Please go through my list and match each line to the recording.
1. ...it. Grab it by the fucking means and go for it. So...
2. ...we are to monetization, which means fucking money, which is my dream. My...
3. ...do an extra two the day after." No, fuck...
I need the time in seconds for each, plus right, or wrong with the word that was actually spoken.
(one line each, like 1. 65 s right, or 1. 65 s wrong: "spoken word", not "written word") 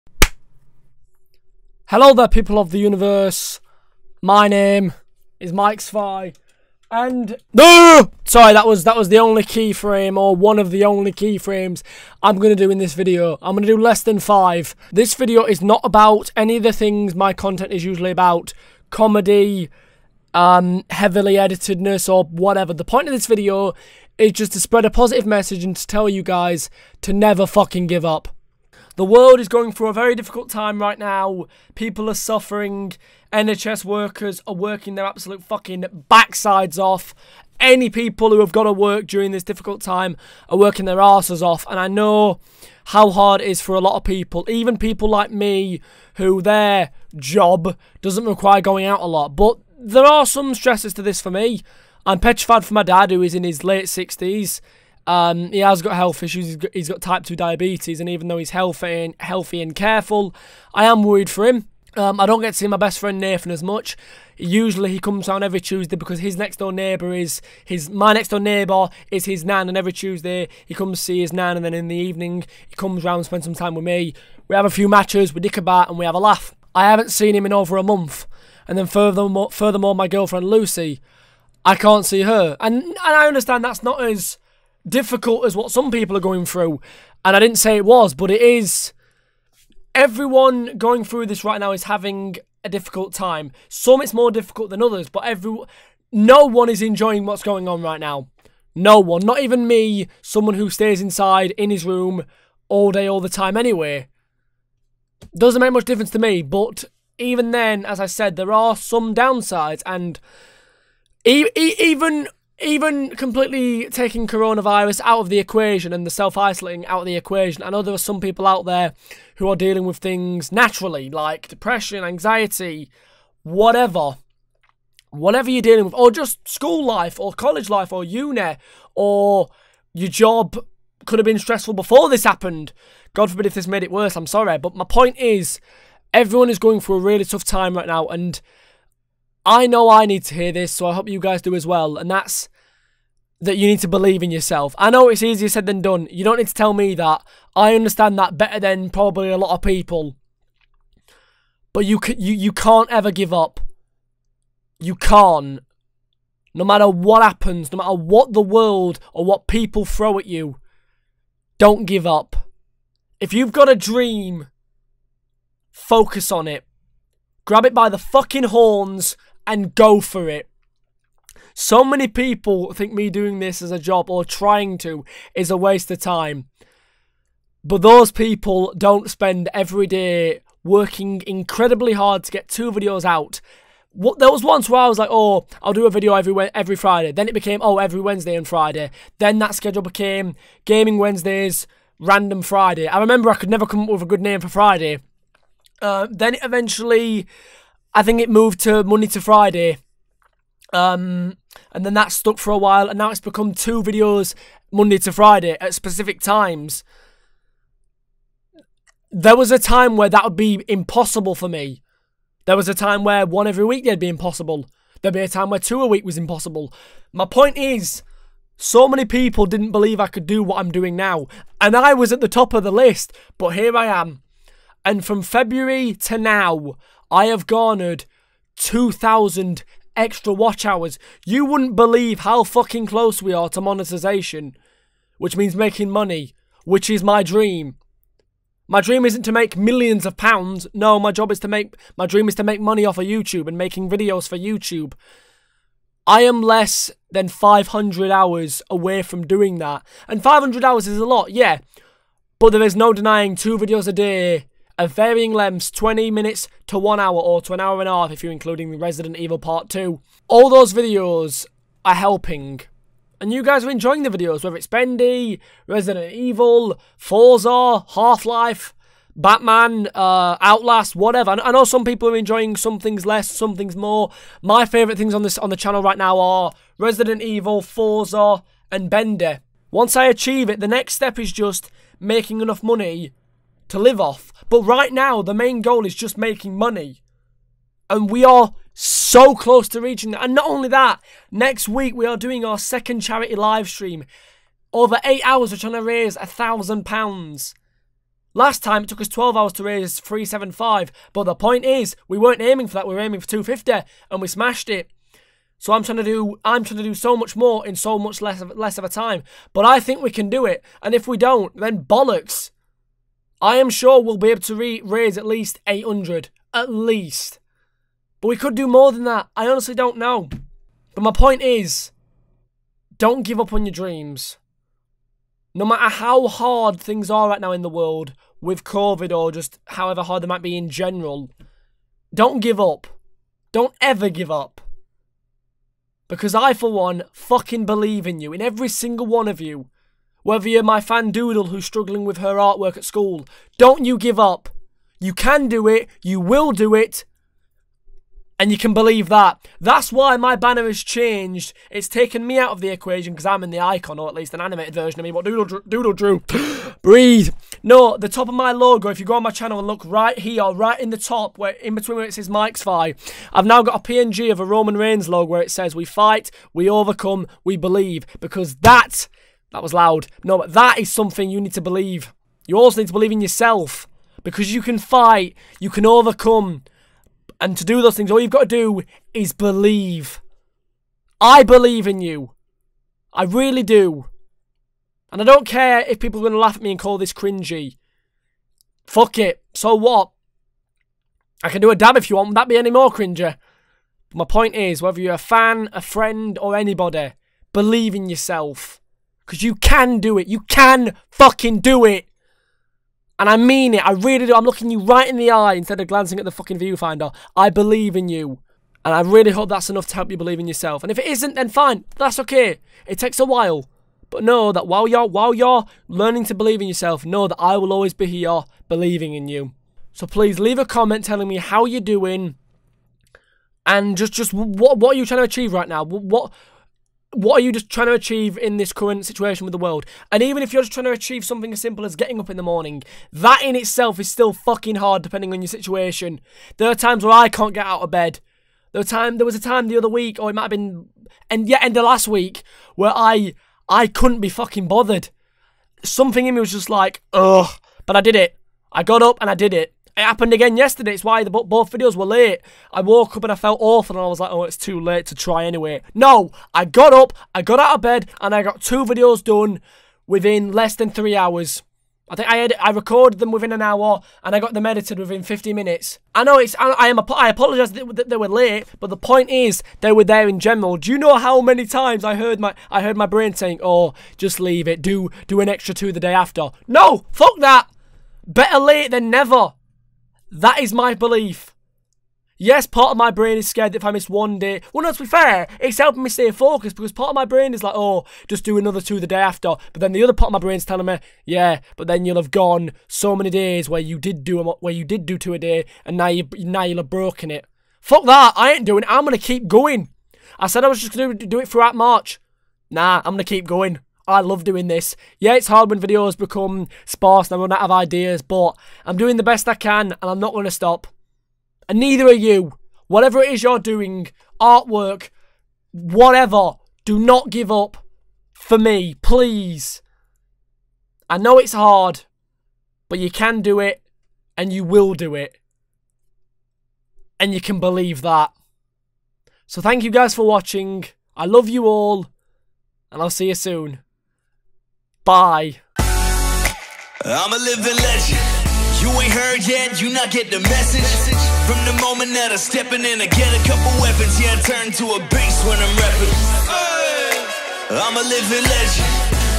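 1. 166 s wrong: "horns", not "means"
2. 233 s wrong: "making", not "fucking"
3. 475 s right.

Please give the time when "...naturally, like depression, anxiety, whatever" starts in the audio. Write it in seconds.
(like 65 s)
120 s.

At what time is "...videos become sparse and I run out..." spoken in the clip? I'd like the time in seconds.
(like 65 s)
505 s.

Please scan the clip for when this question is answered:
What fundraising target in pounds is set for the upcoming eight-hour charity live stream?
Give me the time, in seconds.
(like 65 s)
296 s.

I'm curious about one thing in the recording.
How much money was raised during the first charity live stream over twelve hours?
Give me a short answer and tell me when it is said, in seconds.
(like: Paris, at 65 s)
375, at 299 s.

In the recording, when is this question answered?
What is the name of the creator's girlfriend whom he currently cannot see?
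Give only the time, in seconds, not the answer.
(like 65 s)
80 s.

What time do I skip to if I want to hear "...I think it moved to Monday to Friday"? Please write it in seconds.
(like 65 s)
197 s.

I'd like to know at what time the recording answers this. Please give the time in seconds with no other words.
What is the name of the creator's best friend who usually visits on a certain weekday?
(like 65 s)
63 s.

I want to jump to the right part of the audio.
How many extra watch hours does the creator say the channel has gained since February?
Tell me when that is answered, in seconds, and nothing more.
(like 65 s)
228 s.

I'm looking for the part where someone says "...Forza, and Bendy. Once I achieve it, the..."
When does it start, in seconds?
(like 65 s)
277 s.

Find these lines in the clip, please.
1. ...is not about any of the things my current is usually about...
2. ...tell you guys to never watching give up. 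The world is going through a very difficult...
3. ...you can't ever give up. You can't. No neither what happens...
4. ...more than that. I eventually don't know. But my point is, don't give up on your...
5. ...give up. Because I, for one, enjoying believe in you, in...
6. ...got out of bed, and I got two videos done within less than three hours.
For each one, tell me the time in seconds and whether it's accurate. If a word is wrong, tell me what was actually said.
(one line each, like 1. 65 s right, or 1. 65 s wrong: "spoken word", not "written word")
1. 15 s wrong: "content", not "current"
2. 25 s wrong: "fucking", not "watching"
3. 152 s wrong: "matter", not "neither"
4. 318 s wrong: "honestly", not "eventually"
5. 334 s wrong: "fucking", not "enjoying"
6. 457 s right.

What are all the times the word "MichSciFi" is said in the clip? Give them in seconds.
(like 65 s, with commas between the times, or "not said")
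5 s, 362 s.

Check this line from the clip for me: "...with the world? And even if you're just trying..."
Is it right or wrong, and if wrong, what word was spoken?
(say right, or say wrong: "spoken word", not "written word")
right.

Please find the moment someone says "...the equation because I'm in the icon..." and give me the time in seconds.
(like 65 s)
352 s.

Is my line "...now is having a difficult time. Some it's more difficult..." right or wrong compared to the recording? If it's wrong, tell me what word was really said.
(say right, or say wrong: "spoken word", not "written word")
right.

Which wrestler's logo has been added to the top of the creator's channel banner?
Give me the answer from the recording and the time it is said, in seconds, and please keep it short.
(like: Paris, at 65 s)
Roman Reigns, at 364 s.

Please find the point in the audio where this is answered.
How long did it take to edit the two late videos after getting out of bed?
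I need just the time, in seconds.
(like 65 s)
465 s.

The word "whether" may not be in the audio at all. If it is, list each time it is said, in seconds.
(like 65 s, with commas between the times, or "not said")
264 s, 340 s, 394 s.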